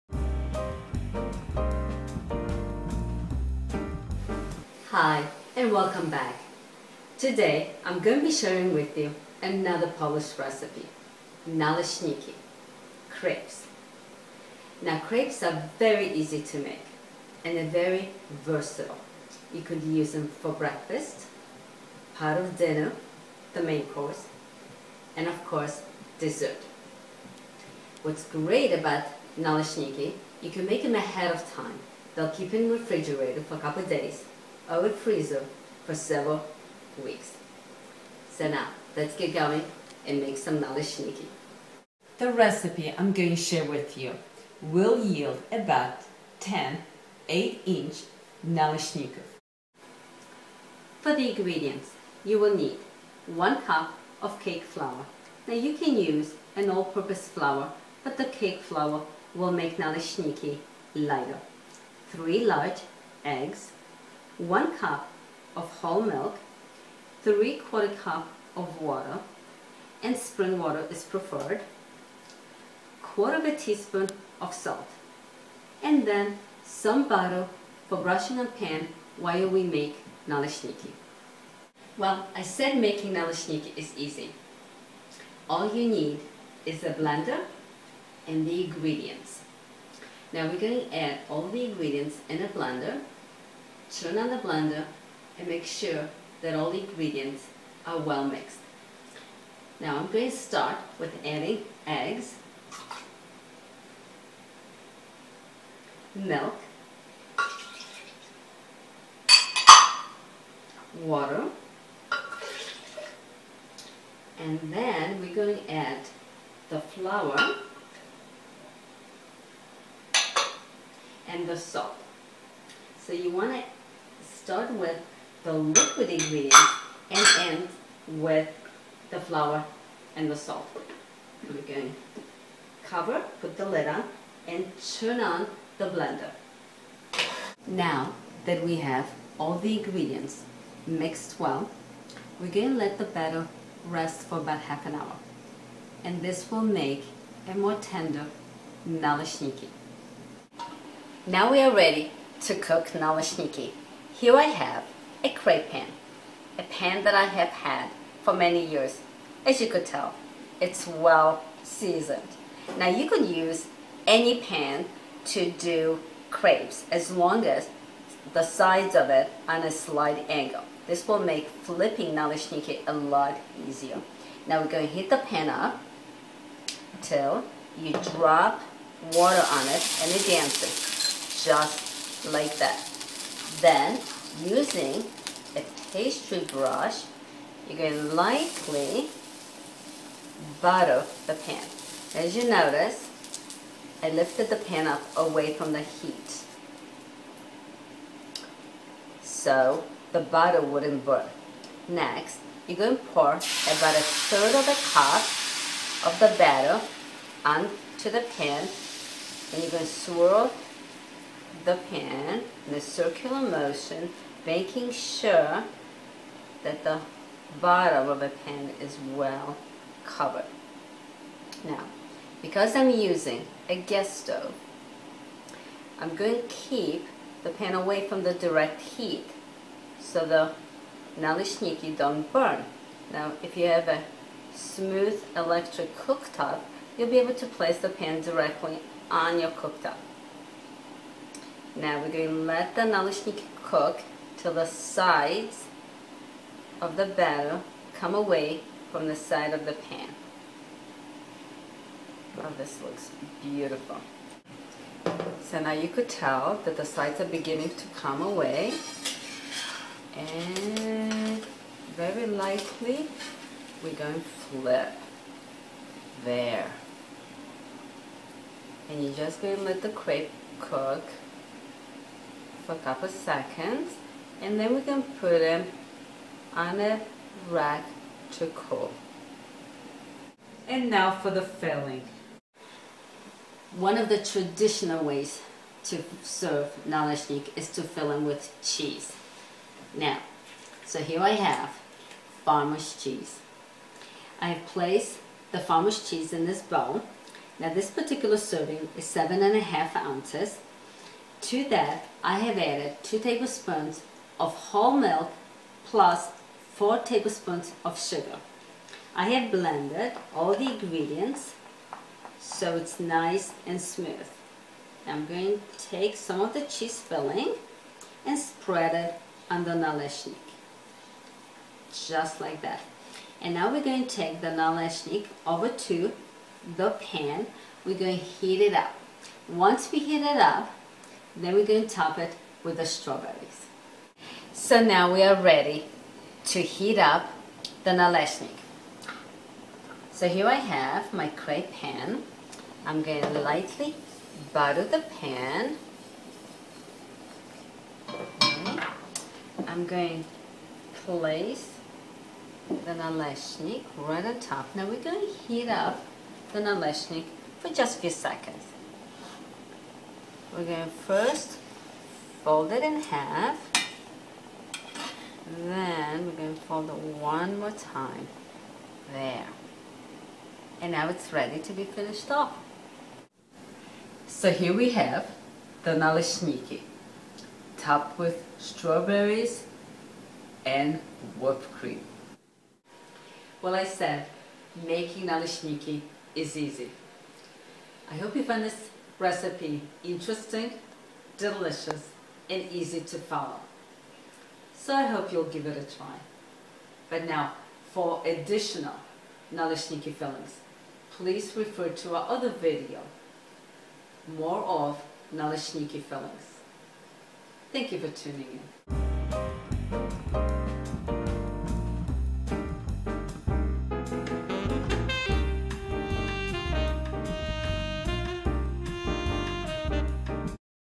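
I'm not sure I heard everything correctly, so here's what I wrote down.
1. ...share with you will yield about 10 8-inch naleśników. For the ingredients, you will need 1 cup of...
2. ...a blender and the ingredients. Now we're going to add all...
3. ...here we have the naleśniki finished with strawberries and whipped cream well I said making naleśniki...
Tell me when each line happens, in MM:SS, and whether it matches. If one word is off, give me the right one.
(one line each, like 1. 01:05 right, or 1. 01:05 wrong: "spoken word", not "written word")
1. 00:43 right
2. 01:26 right
3. 06:14 wrong: "topped", not "finished".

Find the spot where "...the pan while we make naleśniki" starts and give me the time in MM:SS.
01:18.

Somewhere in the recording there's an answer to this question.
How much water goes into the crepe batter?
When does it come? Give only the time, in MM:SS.
01:07.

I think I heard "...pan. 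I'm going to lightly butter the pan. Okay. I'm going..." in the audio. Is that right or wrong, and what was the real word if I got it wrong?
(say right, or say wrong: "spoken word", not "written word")
right.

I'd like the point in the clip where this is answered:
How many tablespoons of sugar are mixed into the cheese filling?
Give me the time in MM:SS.
05:06.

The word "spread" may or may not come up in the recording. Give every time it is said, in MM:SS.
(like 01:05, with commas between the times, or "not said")
05:18.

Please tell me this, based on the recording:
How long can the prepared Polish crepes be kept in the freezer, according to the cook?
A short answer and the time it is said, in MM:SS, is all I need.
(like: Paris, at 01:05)
several weeks, at 00:35.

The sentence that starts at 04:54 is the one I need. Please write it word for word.
I have placed the farmer's cheese in this bowl.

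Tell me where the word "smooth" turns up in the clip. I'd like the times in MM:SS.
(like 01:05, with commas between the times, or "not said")
03:54, 05:13.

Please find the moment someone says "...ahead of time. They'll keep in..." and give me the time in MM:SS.
00:30.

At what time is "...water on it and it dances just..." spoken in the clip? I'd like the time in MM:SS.
02:59.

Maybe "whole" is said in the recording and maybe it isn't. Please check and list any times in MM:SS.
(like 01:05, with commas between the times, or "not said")
01:05, 05:04.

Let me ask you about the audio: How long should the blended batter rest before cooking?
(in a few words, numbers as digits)
half an hour.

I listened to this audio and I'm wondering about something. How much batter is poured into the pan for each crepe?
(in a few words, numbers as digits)
1/3 cup.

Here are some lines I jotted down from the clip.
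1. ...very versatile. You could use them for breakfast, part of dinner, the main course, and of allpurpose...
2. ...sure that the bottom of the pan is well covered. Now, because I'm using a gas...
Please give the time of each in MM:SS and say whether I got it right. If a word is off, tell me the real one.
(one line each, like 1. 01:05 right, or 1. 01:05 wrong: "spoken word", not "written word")
1. 00:17 wrong: "course", not "allpurpose"
2. 03:34 right.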